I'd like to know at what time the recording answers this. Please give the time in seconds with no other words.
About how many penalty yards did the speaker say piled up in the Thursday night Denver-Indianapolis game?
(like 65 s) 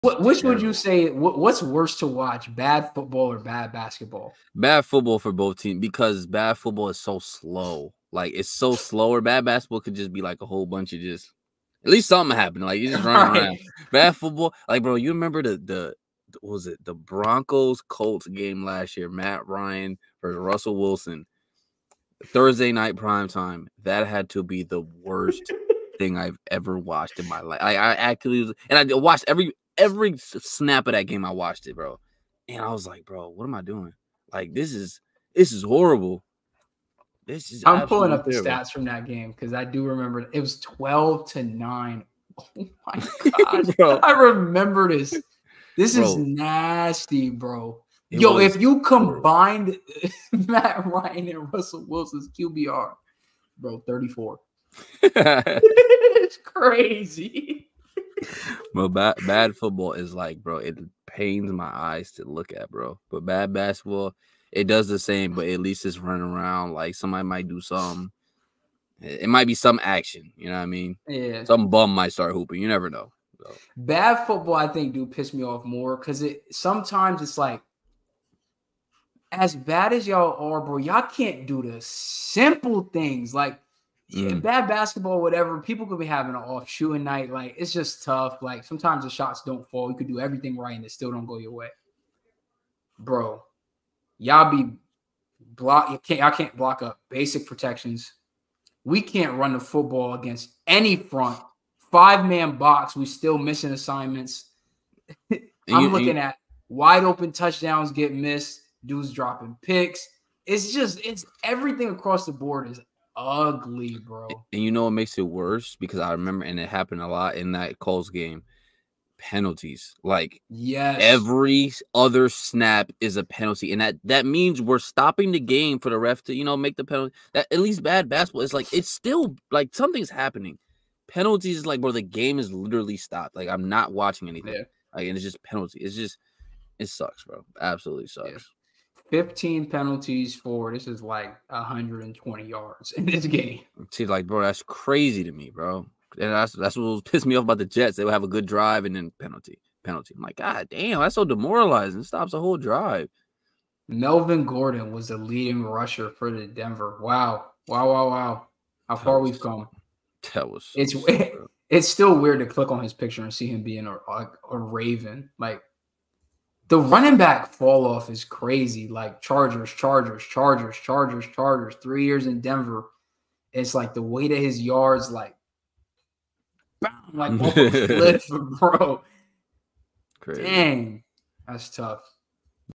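141 s.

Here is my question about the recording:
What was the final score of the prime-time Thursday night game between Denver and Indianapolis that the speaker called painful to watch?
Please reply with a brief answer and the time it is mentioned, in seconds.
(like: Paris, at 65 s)
12 to 9, at 40 s.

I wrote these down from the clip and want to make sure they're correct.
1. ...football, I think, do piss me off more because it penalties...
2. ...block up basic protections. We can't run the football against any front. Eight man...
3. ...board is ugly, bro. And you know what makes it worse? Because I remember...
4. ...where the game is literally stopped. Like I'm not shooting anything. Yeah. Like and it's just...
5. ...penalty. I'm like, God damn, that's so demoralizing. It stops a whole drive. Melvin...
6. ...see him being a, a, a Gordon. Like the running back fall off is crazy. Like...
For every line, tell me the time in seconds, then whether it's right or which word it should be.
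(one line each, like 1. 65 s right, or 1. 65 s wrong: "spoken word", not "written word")
1. 74 s wrong: "sometimes", not "penalties"
2. 96 s wrong: "Five", not "Eight"
3. 112 s right
4. 131 s wrong: "watching", not "shooting"
5. 149 s right
6. 163 s wrong: "Raven", not "Gordon".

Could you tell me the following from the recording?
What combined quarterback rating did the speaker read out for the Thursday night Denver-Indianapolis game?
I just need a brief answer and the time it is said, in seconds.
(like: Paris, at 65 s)
34, at 53 s.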